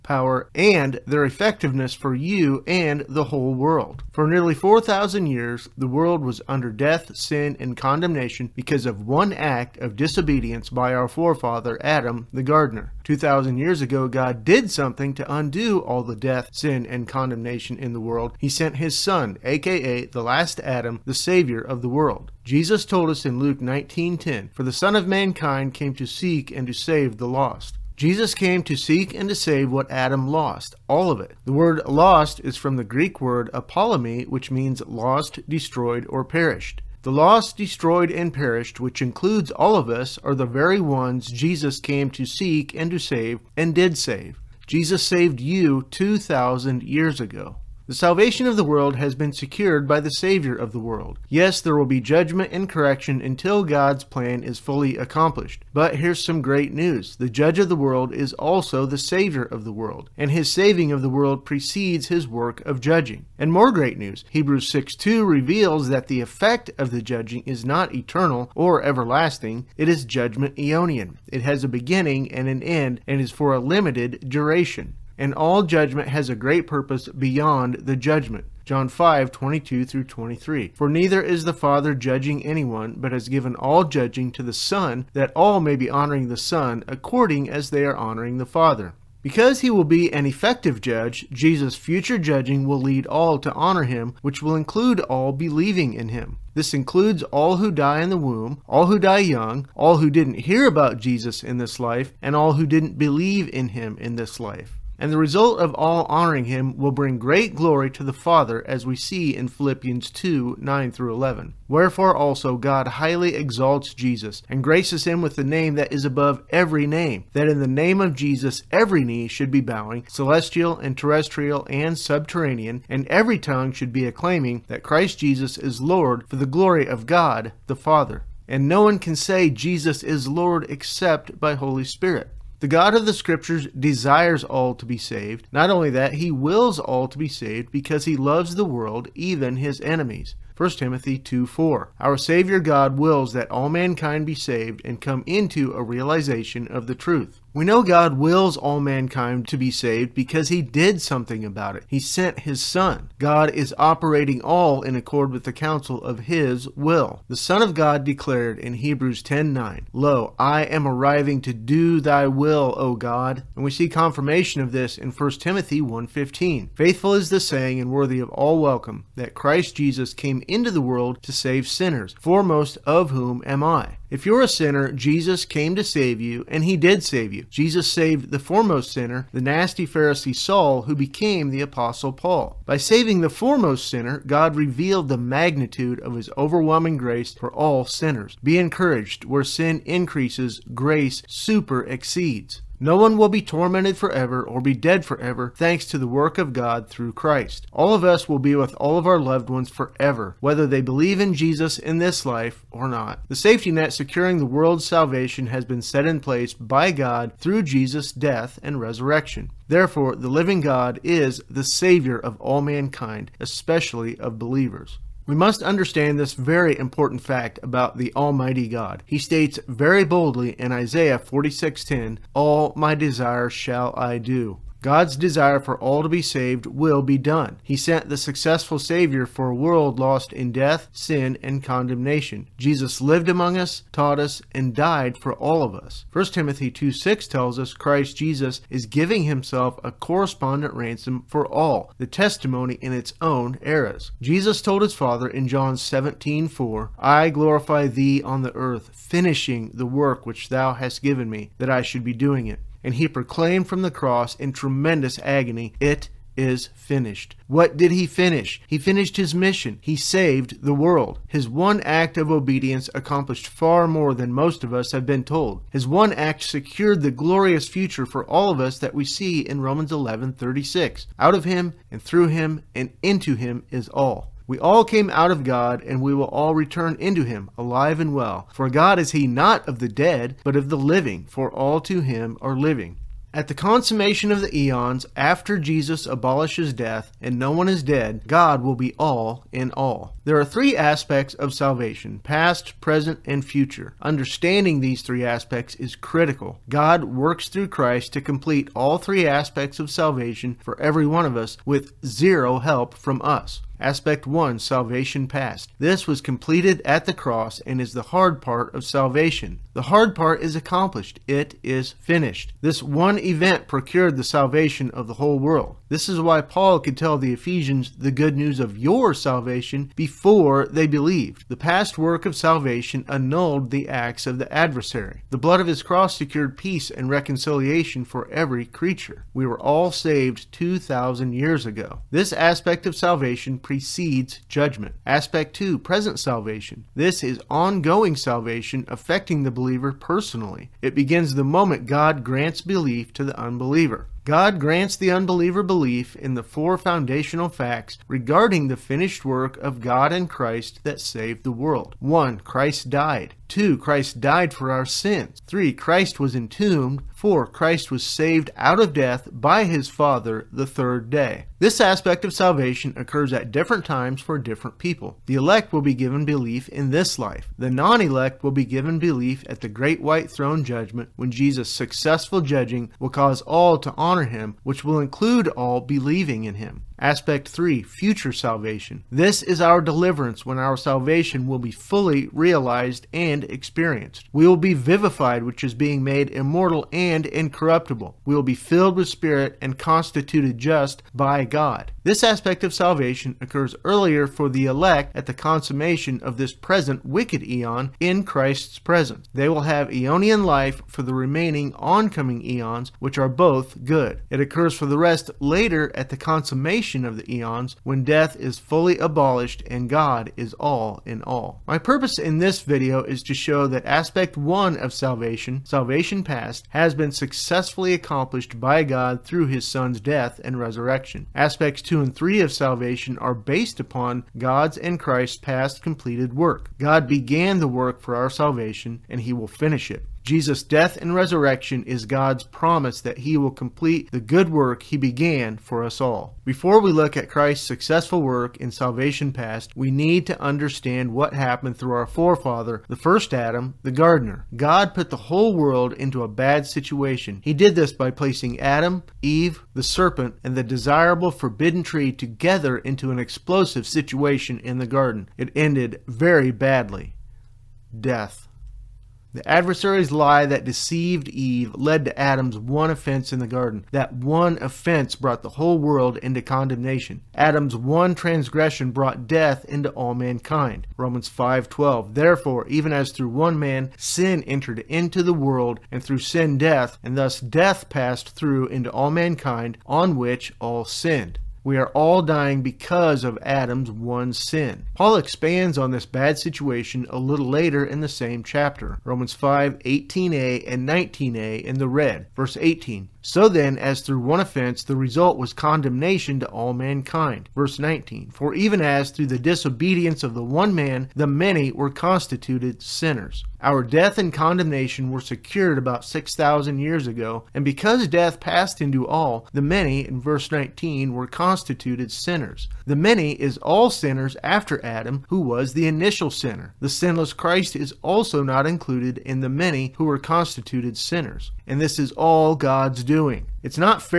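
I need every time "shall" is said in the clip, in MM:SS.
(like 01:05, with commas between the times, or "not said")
03:43.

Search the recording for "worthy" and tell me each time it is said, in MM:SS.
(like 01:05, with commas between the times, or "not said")
02:47.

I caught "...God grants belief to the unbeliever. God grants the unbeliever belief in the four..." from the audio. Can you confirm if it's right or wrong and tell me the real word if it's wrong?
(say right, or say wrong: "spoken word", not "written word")
right.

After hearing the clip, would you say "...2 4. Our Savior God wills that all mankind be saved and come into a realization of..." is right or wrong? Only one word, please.
right.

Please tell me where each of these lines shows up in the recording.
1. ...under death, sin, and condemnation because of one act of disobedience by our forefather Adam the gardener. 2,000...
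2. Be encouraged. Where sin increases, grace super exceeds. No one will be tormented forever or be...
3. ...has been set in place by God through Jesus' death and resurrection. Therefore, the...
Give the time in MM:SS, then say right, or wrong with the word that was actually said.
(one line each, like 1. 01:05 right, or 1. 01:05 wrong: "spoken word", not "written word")
1. 00:06 right
2. 03:08 right
3. 03:25 right.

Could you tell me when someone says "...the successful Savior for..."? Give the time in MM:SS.
03:48.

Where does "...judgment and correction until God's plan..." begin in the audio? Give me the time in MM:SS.
00:52.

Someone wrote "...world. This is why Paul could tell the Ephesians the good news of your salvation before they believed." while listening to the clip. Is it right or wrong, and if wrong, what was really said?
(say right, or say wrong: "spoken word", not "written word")
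right.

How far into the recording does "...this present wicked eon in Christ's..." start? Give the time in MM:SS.
06:36.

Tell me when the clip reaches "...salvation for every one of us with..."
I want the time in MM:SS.
04:59.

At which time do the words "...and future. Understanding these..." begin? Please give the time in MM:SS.
04:53.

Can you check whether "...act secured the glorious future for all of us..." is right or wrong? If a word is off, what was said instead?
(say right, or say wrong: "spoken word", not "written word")
right.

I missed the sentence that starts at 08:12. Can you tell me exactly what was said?
Verse 18, so then, as through one offense, the result was condemnation to all mankind.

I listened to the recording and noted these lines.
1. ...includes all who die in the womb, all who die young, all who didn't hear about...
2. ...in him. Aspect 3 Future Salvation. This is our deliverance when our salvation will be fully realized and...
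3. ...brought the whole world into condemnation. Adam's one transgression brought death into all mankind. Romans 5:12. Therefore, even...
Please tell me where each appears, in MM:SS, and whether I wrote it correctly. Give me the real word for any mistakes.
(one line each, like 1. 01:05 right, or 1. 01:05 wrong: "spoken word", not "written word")
1. 01:36 right
2. 06:16 right
3. 07:45 right.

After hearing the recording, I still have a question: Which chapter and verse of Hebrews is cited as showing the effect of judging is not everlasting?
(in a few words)
Hebrews 6:2.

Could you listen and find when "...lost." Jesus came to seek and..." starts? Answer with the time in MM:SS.
00:27.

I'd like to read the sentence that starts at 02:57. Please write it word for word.
Jesus saved the foremost sinner, the nasty Pharisee Saul, who became the Apostle Paul.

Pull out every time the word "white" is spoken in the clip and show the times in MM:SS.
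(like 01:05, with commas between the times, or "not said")
06:10.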